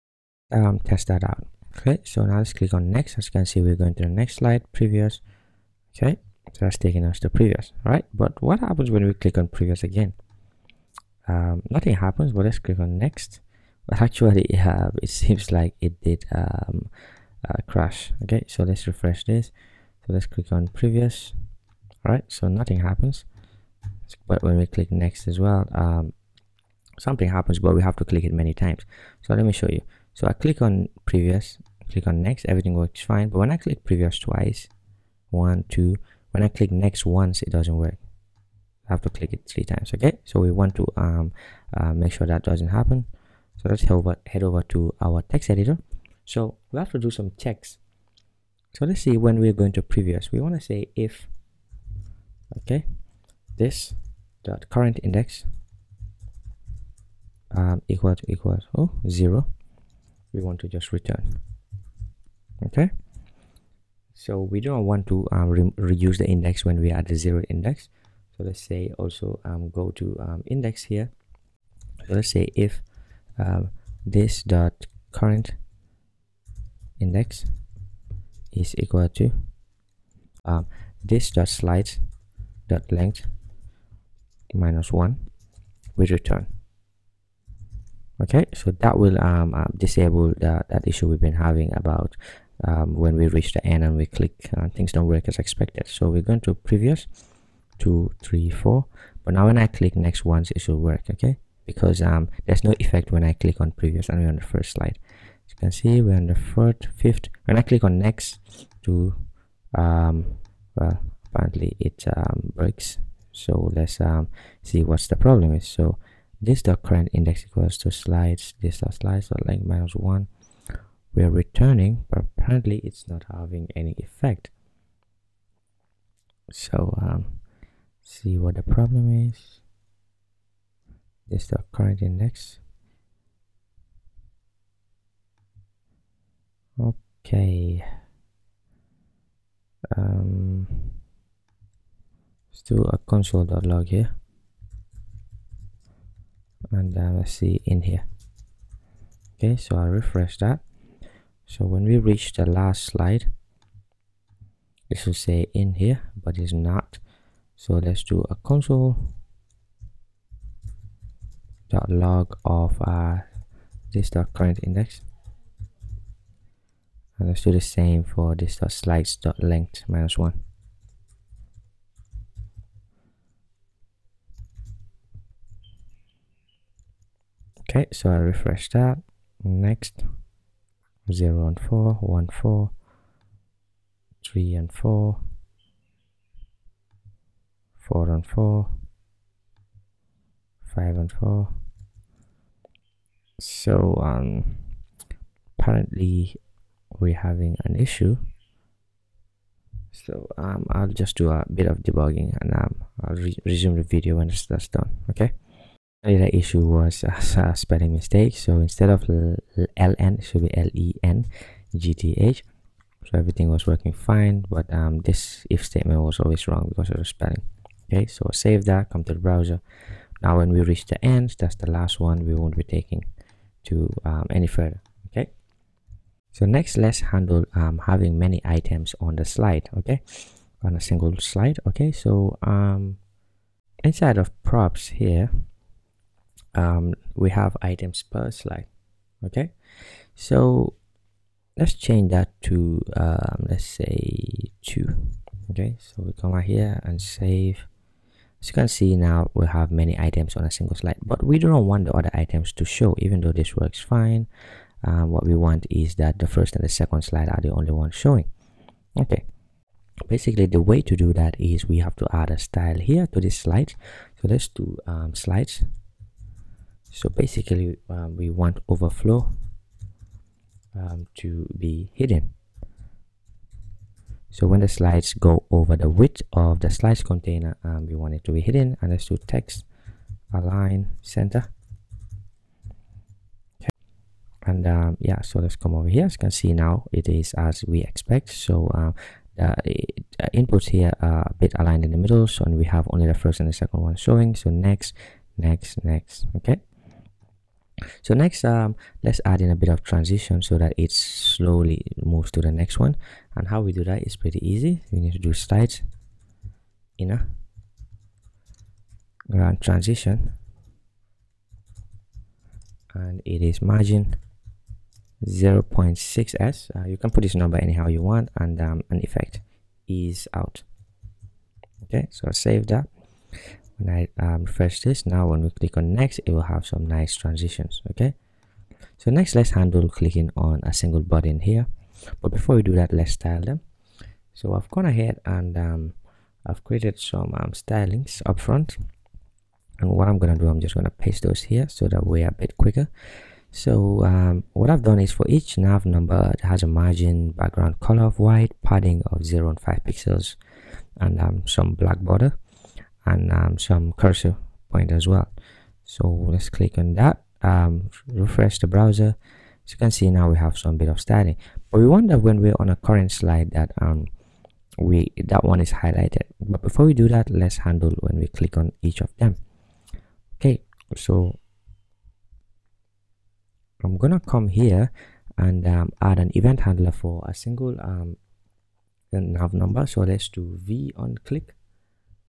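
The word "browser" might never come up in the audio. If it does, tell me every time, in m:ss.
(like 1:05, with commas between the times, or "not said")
3:39, 5:58.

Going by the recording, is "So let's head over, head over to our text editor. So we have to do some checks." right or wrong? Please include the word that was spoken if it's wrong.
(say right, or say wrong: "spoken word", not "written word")
right.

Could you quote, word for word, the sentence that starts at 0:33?
But when I click previous twice, one, two, when I click next once, it doesn't work.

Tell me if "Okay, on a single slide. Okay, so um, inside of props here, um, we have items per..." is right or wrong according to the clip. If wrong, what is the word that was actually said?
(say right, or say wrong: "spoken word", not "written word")
right.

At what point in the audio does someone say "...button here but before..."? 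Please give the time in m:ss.
5:31.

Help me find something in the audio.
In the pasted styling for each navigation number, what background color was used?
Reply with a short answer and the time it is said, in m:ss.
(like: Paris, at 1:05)
white, at 5:48.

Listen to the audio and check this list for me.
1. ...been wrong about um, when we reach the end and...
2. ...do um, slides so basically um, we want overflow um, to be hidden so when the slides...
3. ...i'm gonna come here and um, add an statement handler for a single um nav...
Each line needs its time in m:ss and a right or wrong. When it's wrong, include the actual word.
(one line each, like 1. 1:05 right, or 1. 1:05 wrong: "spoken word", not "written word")
1. 1:31 wrong: "having", not "wrong"
2. 4:24 right
3. 6:13 wrong: "event", not "statement".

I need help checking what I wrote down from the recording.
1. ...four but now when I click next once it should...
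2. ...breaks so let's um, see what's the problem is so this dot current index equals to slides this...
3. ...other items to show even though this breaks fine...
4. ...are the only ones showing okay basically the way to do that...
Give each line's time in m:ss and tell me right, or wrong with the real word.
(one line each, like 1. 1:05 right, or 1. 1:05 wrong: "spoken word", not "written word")
1. 1:38 right
2. 1:52 right
3. 4:11 wrong: "works", not "breaks"
4. 4:17 right.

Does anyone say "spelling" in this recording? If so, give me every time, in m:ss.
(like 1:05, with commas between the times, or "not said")
3:27, 3:37.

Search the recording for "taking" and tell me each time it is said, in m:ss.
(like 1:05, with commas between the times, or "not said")
0:06, 3:42.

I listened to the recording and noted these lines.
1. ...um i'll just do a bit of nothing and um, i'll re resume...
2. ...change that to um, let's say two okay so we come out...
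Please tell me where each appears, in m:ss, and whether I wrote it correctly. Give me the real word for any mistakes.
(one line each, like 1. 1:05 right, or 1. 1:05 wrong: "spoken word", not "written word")
1. 3:20 wrong: "debugging", not "nothing"
2. 4:01 right.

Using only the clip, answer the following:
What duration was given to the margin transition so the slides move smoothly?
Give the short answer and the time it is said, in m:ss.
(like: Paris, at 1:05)
0.6s, at 5:15.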